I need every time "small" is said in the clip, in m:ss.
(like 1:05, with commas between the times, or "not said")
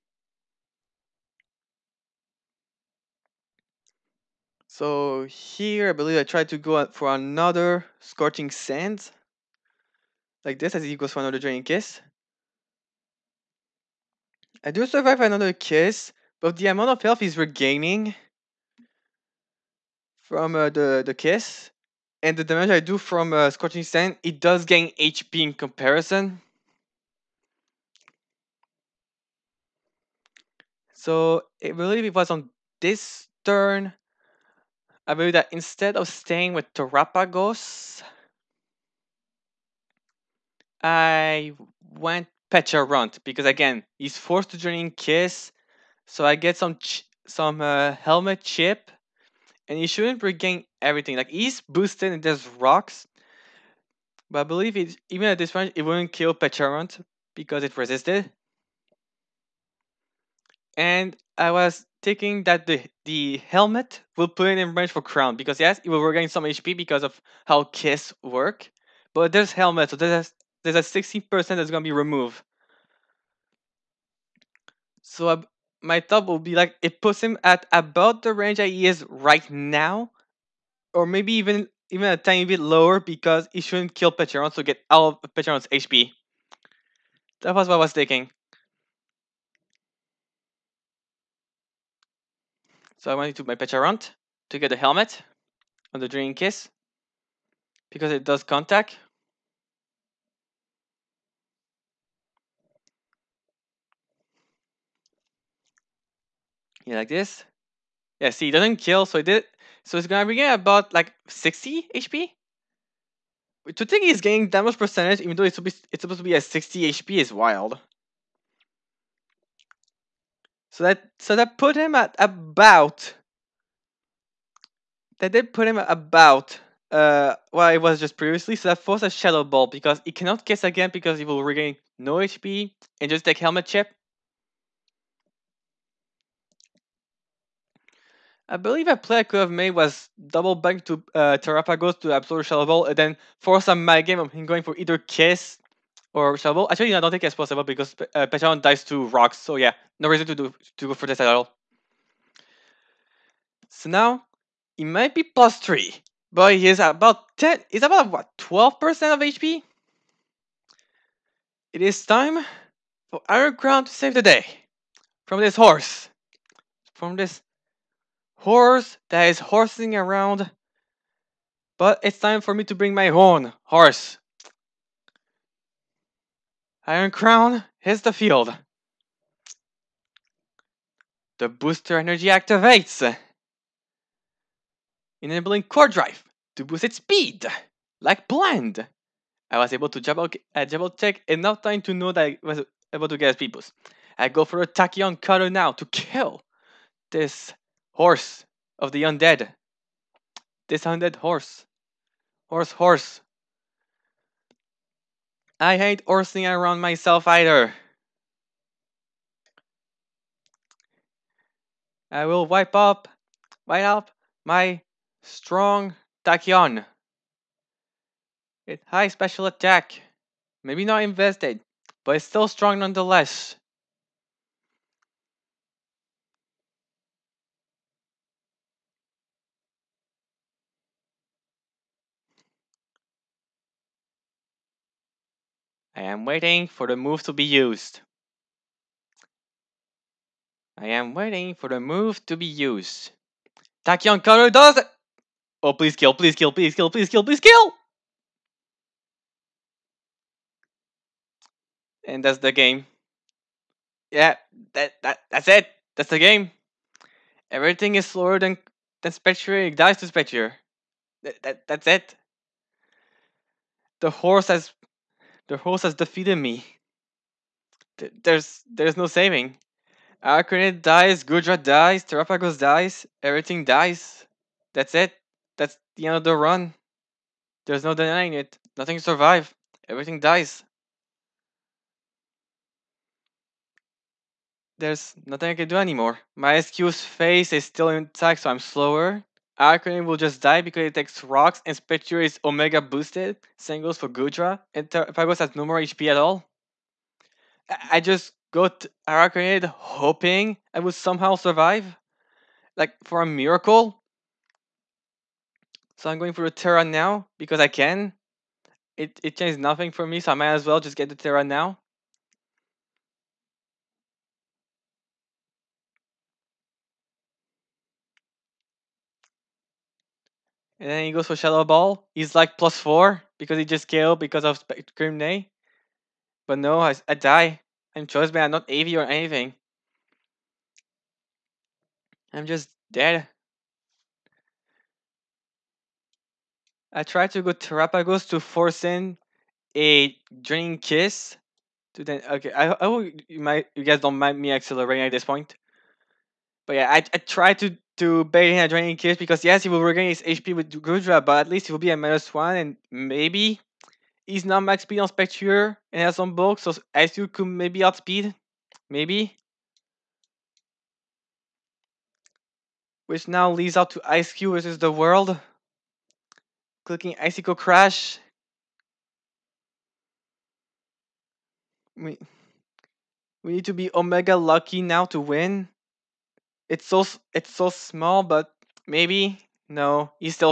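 6:17.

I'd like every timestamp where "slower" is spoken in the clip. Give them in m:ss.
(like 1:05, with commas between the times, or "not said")
4:18, 4:48.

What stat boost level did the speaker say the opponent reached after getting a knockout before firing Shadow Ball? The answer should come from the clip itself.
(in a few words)
plus four.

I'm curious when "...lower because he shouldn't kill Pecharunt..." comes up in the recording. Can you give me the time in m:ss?
1:22.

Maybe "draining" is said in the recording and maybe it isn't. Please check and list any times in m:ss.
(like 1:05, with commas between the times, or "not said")
0:11, 5:40, 5:48.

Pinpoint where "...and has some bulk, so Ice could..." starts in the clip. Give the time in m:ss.
5:55.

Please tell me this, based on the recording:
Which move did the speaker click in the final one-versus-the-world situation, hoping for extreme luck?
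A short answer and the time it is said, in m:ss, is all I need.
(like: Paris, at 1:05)
Icicle Crash, at 6:07.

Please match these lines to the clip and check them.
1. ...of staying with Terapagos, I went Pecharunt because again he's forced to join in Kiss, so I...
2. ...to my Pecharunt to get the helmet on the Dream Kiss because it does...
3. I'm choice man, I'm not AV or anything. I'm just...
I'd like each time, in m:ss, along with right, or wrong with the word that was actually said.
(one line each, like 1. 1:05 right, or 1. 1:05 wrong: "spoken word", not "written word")
1. 0:35 right
2. 1:33 right
3. 5:27 right.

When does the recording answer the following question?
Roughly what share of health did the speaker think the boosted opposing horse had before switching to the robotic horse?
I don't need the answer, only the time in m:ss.
2:38.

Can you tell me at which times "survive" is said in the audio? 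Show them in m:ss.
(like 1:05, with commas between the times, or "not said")
0:14, 4:38, 5:01.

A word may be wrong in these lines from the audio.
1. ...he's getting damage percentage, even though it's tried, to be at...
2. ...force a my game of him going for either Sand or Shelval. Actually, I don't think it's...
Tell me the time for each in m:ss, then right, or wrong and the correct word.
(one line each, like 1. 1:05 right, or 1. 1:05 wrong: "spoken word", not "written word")
1. 1:54 wrong: "supposed", not "tried"
2. 2:23 wrong: "Kiss", not "Sand".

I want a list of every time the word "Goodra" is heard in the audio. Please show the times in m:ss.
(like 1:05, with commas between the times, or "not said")
4:31, 4:54, 5:50.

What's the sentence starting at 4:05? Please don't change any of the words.
Oh, please kill, please kill, please kill, please kill, please kill!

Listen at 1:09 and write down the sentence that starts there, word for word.
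But there's helmet, so there's there's a 60% that's gonna be removed.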